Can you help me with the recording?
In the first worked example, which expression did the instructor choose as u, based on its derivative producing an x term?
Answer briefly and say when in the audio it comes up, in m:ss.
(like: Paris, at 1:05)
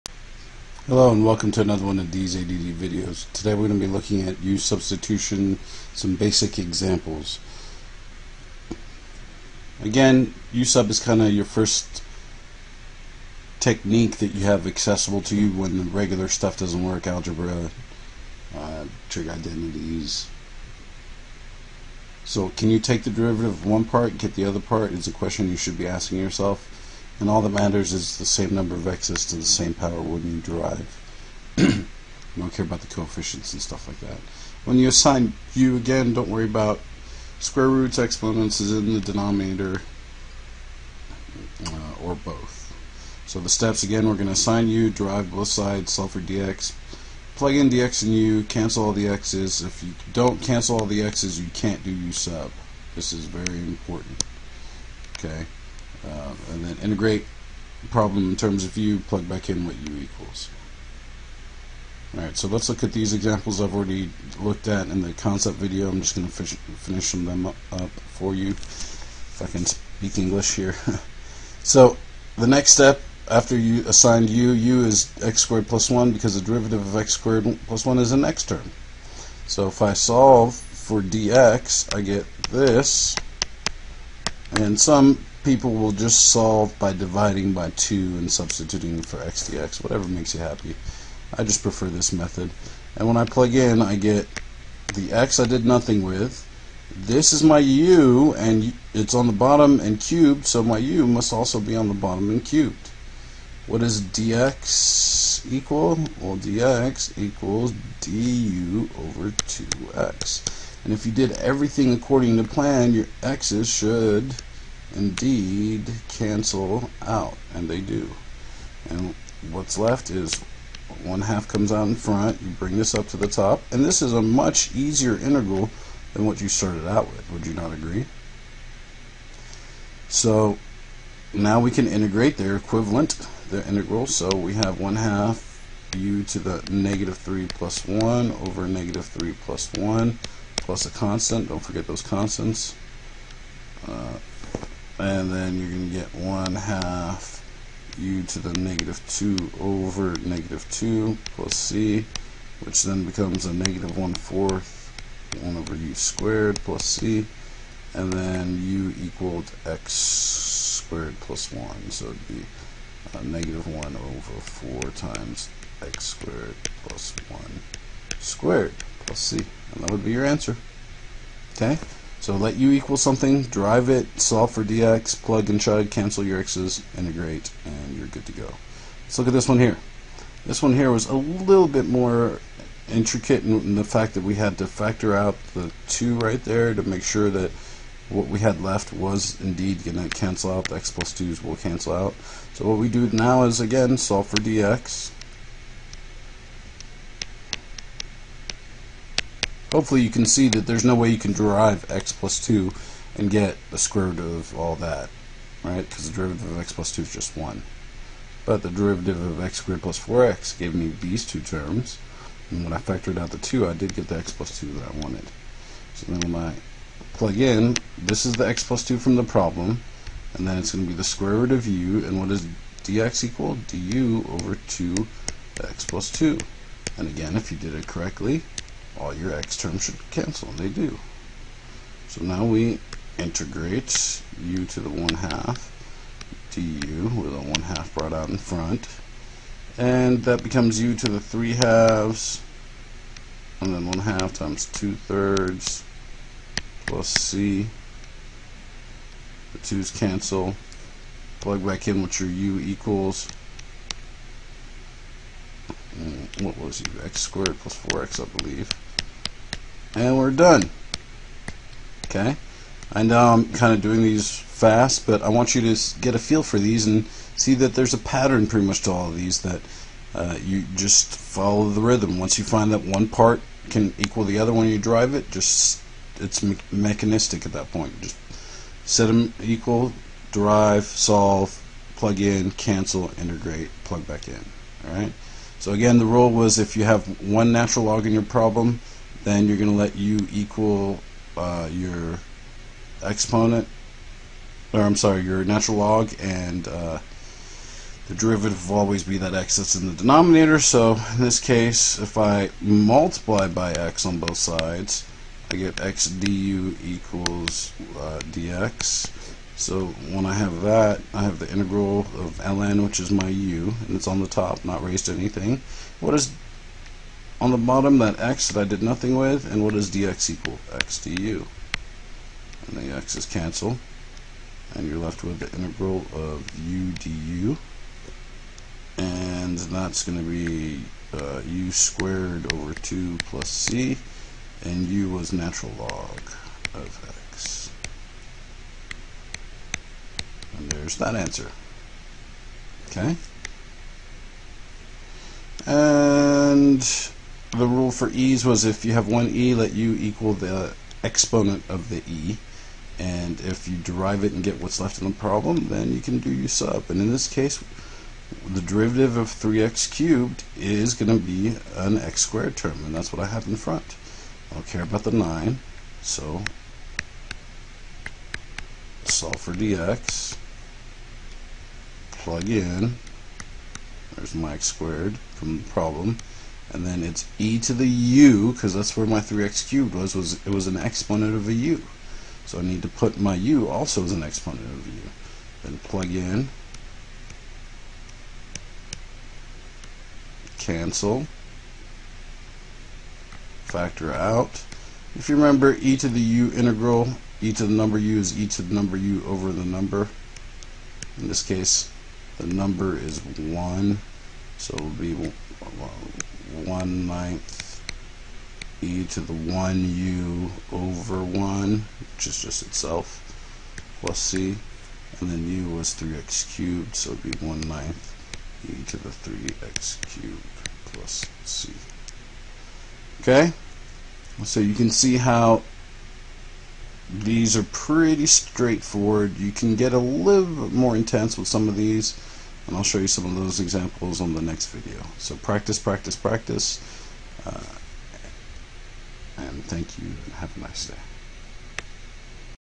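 x squared plus 1, at 1:14.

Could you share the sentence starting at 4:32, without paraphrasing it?
Once you find that one part can equal the other when you drive it, just it's me mechanistic at that point.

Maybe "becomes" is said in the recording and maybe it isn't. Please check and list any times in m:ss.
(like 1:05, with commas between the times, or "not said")
2:33, 4:00.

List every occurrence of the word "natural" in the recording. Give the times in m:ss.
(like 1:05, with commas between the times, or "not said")
4:47, 4:55, 5:35.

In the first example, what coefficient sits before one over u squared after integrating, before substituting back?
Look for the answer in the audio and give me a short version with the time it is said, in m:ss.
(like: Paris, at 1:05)
negative 1/4, at 2:33.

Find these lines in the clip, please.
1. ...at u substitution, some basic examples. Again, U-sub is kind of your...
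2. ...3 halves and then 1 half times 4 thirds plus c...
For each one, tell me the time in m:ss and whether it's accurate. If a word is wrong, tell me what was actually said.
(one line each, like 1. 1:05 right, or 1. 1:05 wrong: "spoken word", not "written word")
1. 0:04 right
2. 4:01 wrong: "2", not "4".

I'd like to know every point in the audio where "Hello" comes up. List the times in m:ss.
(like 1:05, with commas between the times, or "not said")
0:00.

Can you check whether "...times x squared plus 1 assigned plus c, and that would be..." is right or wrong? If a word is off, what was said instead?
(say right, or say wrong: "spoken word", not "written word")
wrong: "squared", not "assigned".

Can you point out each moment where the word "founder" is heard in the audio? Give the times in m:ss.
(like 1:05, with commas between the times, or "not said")
not said.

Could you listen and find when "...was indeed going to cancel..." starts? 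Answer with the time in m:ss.
3:08.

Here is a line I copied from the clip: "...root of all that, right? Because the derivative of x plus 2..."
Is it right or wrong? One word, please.
right.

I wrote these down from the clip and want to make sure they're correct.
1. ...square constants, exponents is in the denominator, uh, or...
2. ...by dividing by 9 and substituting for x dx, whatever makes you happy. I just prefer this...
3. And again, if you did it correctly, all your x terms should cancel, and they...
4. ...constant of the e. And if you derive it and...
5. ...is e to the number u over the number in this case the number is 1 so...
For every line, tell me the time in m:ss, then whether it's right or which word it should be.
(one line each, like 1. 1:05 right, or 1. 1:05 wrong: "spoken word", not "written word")
1. 0:37 wrong: "roots", not "constants"
2. 1:26 wrong: "2", not "9"
3. 3:46 right
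4. 5:51 wrong: "exponent", not "constant"
5. 6:38 right.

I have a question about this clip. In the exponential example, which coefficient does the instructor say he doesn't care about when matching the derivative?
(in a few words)
9.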